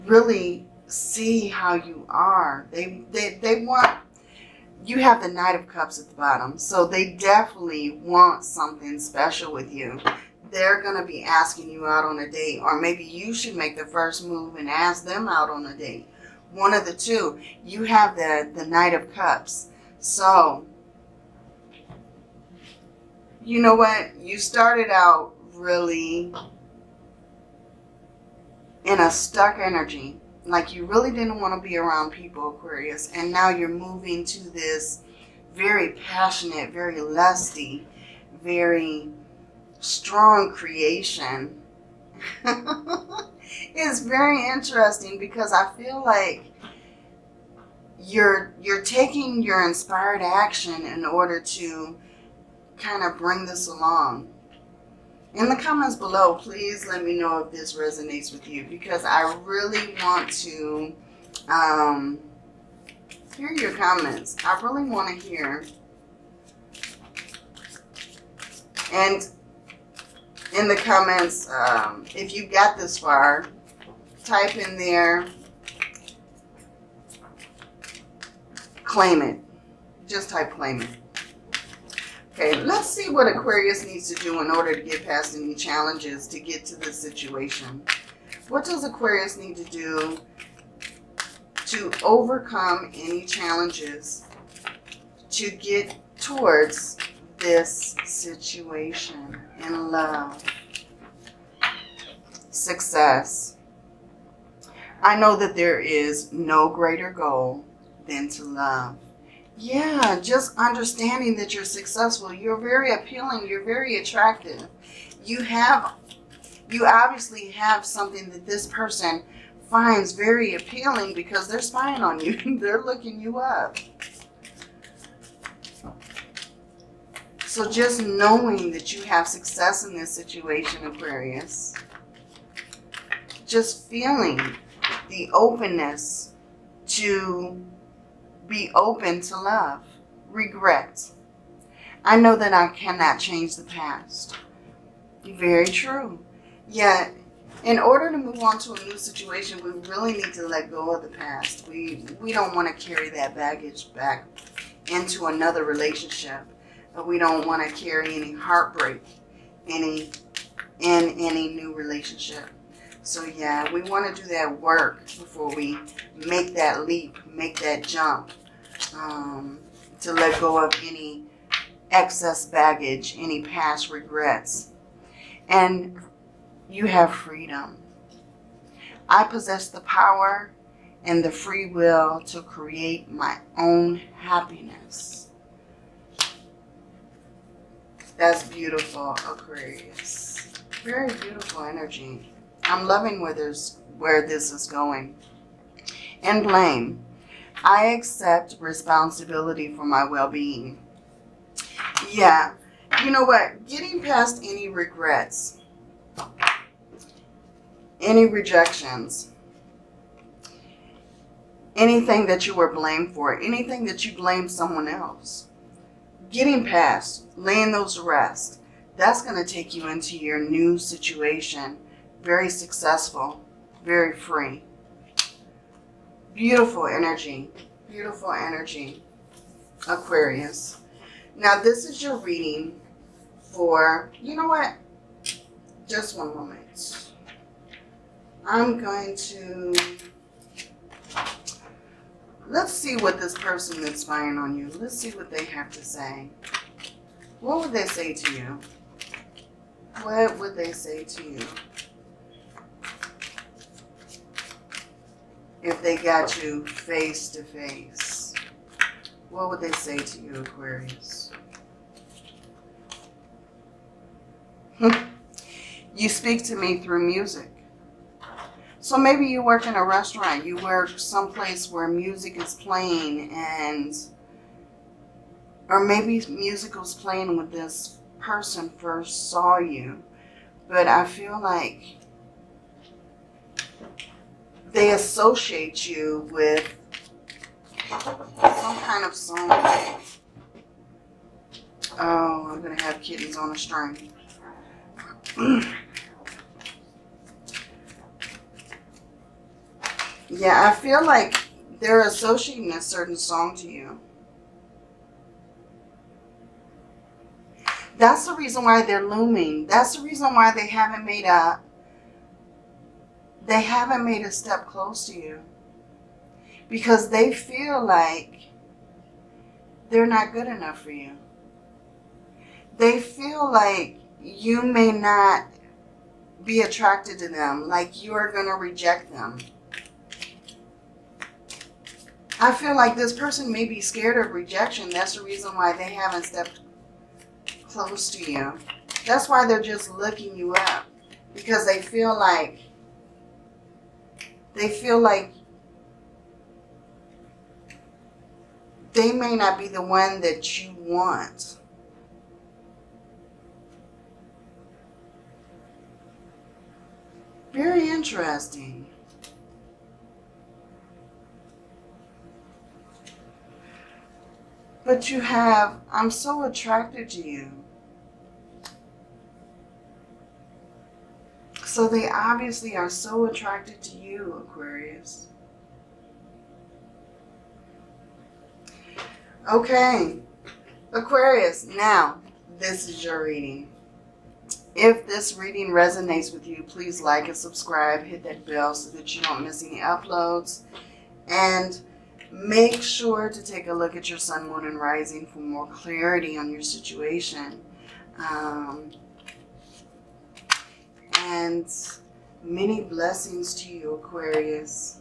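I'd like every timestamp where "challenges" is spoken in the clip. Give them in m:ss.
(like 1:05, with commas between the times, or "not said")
1:25, 1:33.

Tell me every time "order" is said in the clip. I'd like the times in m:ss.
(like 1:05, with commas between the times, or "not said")
0:51, 1:24, 2:27.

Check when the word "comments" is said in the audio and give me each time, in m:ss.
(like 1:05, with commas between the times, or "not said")
0:55, 1:03, 1:10.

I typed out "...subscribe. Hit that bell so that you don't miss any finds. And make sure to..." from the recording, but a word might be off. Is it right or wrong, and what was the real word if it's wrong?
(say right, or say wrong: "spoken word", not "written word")
wrong: "uploads", not "finds".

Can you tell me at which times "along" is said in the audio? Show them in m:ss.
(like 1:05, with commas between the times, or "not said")
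0:53.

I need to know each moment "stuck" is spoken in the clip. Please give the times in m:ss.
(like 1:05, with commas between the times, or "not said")
0:29.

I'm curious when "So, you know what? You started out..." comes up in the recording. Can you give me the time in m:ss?
0:19.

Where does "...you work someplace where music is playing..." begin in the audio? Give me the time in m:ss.
4:30.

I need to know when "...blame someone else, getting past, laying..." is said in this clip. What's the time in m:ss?
3:34.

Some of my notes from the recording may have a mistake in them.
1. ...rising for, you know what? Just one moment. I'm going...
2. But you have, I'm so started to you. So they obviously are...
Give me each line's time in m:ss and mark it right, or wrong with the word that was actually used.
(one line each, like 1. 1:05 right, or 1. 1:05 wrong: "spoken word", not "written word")
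1. 3:52 wrong: "reading", not "rising"
2. 6:04 wrong: "attracted", not "started".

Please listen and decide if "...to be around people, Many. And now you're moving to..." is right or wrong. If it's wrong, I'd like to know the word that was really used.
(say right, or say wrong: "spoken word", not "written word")
wrong: "Aquarius", not "Many".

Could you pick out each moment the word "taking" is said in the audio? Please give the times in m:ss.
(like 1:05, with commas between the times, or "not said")
0:48.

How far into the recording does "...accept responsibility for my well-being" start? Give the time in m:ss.
3:17.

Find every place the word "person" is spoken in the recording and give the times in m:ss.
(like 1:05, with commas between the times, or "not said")
1:58, 4:03, 4:38, 5:33.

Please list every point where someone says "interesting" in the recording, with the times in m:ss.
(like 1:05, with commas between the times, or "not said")
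0:44, 5:57.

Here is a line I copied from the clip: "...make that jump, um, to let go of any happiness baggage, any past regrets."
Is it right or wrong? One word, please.
wrong.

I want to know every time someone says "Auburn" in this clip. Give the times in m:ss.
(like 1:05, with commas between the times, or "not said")
not said.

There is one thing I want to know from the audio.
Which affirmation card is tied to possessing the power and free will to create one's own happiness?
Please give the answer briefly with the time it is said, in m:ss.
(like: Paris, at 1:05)
Freedom, at 2:57.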